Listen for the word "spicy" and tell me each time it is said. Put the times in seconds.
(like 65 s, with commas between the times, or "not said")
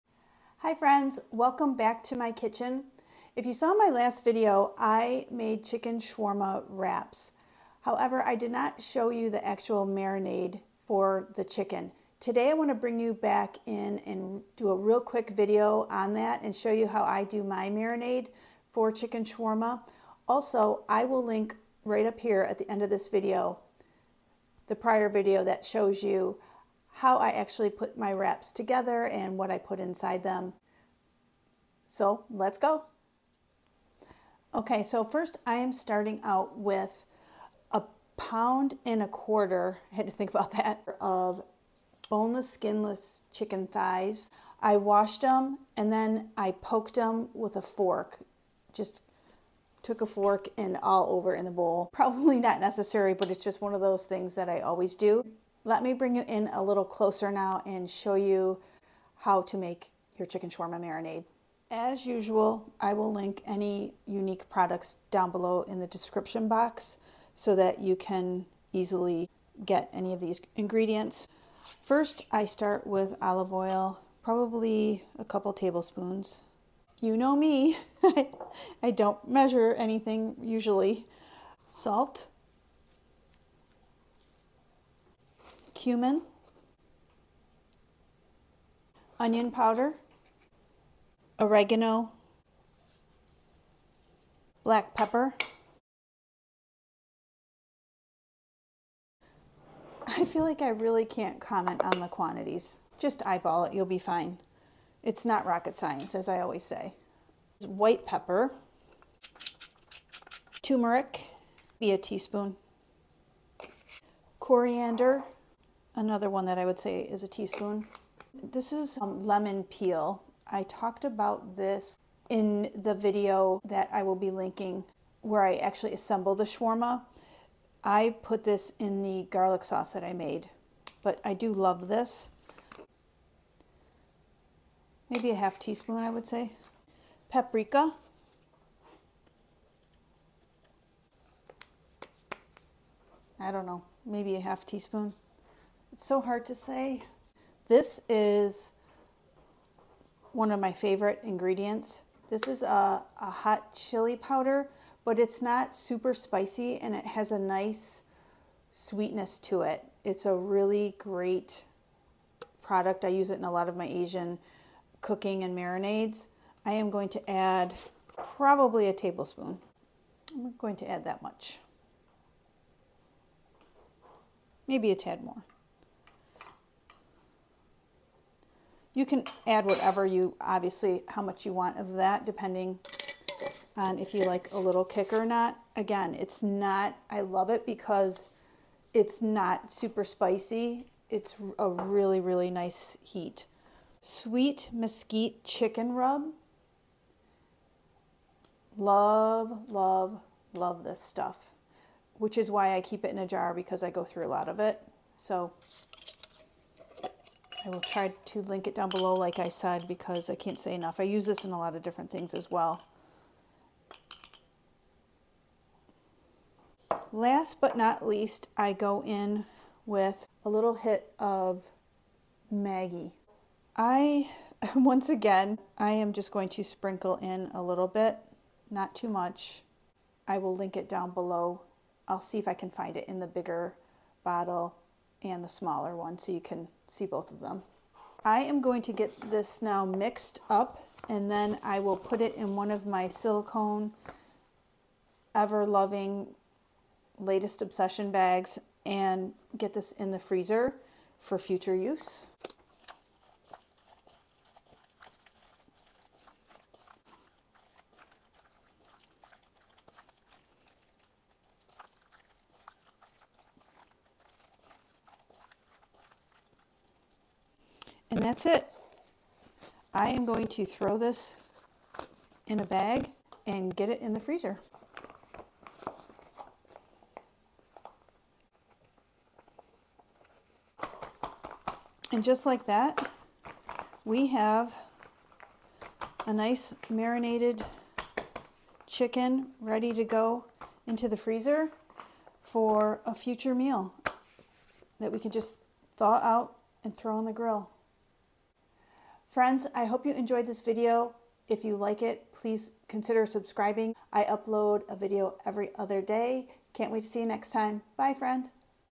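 156 s, 190 s.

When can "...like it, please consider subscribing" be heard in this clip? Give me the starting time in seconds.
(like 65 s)
301 s.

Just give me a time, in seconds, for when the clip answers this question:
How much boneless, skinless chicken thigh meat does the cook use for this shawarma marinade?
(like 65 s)
37 s.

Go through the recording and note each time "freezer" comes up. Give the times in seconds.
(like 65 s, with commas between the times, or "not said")
250 s, 274 s, 291 s.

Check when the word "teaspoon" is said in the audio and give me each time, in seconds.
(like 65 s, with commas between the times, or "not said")
111 s, 117 s, 135 s, 144 s.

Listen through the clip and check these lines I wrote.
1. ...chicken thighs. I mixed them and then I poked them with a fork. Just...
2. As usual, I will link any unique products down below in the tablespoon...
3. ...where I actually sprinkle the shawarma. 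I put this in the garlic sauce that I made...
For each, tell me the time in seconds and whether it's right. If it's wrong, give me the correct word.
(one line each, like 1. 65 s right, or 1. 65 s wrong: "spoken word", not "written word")
1. 43 s wrong: "washed", not "mixed"
2. 61 s wrong: "description", not "tablespoon"
3. 125 s wrong: "assemble", not "sprinkle".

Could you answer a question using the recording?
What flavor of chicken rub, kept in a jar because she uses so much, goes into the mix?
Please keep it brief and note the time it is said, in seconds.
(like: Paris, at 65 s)
Sweet mesquite, at 194 s.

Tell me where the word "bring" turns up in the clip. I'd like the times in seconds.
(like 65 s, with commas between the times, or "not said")
12 s, 55 s.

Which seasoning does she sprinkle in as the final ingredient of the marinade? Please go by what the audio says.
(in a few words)
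Maggi.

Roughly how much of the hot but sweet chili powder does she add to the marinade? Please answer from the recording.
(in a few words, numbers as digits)
A tablespoon.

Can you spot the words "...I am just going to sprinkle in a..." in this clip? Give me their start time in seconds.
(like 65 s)
225 s.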